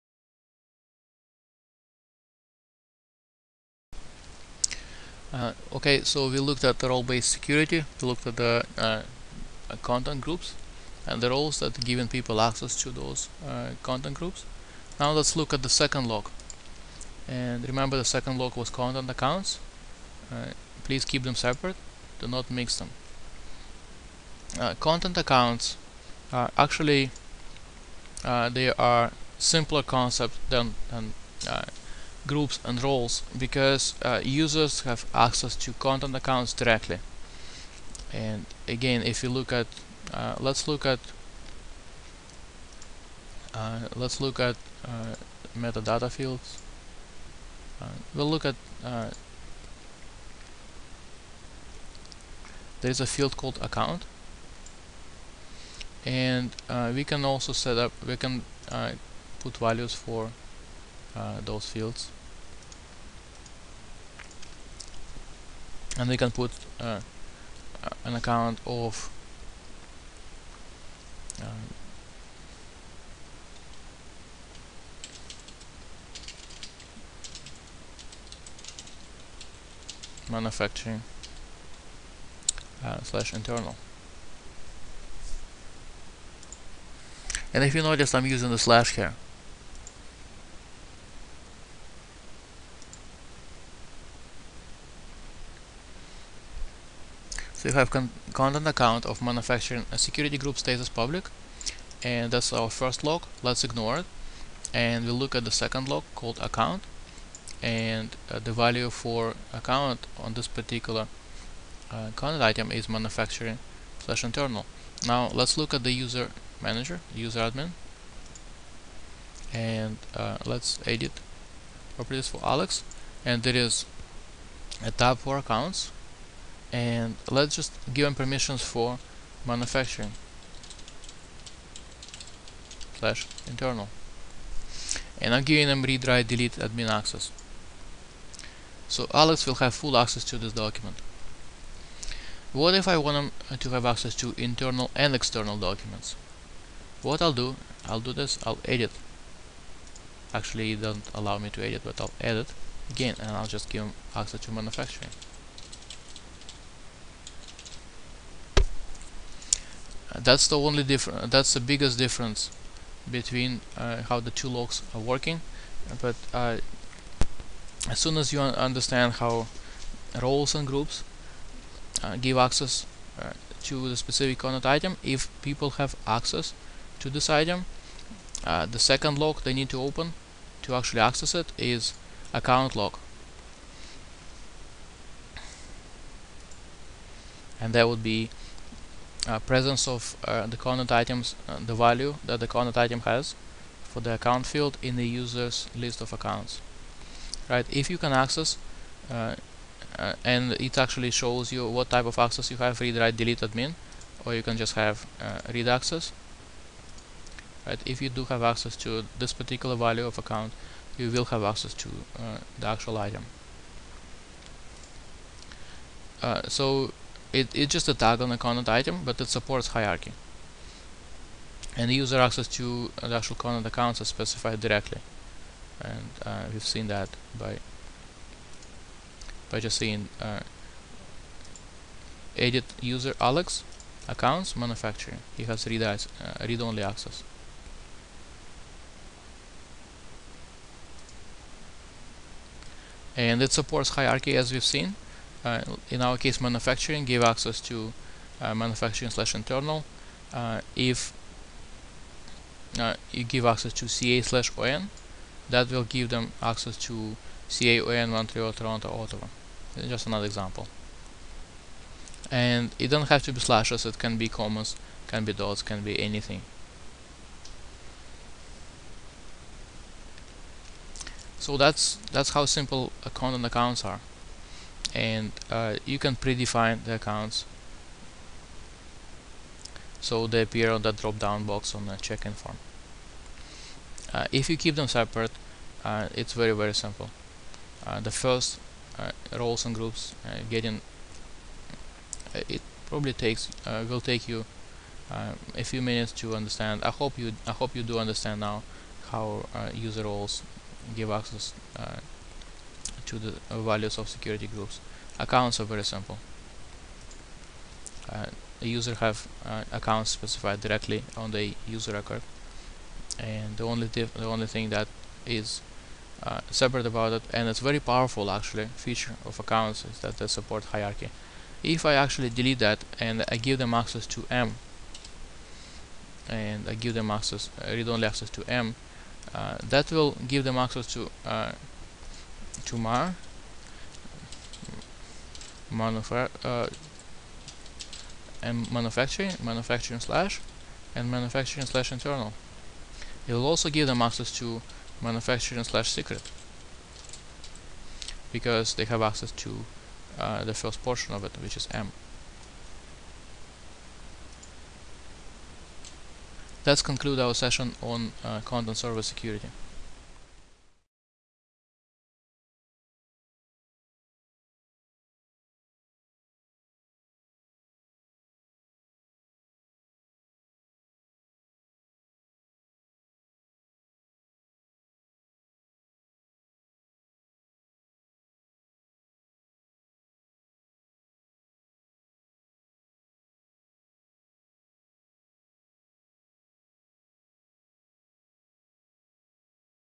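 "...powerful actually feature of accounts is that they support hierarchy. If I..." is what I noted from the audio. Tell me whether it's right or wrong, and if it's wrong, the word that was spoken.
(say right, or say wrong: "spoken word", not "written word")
right.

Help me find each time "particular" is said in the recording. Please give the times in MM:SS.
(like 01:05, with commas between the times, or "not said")
01:50, 03:29.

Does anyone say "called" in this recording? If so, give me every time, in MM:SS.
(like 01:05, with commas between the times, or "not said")
00:53, 01:46.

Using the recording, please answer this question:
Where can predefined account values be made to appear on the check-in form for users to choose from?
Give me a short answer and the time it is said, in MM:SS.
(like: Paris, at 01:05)
drop down box, at 04:40.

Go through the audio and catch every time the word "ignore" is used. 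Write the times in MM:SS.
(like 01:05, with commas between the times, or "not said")
01:43.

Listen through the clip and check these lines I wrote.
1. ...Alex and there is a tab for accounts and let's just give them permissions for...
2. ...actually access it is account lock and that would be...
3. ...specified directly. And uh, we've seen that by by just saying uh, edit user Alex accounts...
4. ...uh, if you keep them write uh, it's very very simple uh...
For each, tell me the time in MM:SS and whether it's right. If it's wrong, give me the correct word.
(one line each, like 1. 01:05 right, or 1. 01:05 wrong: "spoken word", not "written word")
1. 02:02 right
2. 03:00 right
3. 03:44 right
4. 04:44 wrong: "separate", not "write".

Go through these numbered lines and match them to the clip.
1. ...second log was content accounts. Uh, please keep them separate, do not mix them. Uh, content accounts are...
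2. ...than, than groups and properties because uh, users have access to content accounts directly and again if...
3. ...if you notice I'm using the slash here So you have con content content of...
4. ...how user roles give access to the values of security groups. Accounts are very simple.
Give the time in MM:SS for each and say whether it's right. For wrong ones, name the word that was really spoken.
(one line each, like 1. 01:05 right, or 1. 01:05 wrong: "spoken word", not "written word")
1. 00:18 right
2. 00:30 wrong: "roles", not "properties"
3. 01:27 wrong: "account", not "content"
4. 04:59 right.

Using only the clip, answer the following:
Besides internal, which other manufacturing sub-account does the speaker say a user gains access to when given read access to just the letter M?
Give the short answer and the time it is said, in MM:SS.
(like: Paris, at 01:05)
secret, at 05:45.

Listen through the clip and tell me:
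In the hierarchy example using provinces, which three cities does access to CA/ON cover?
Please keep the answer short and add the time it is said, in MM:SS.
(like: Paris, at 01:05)
Montreal, Toronto, Ottawa, at 04:18.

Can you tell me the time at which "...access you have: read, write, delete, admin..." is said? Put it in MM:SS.
03:22.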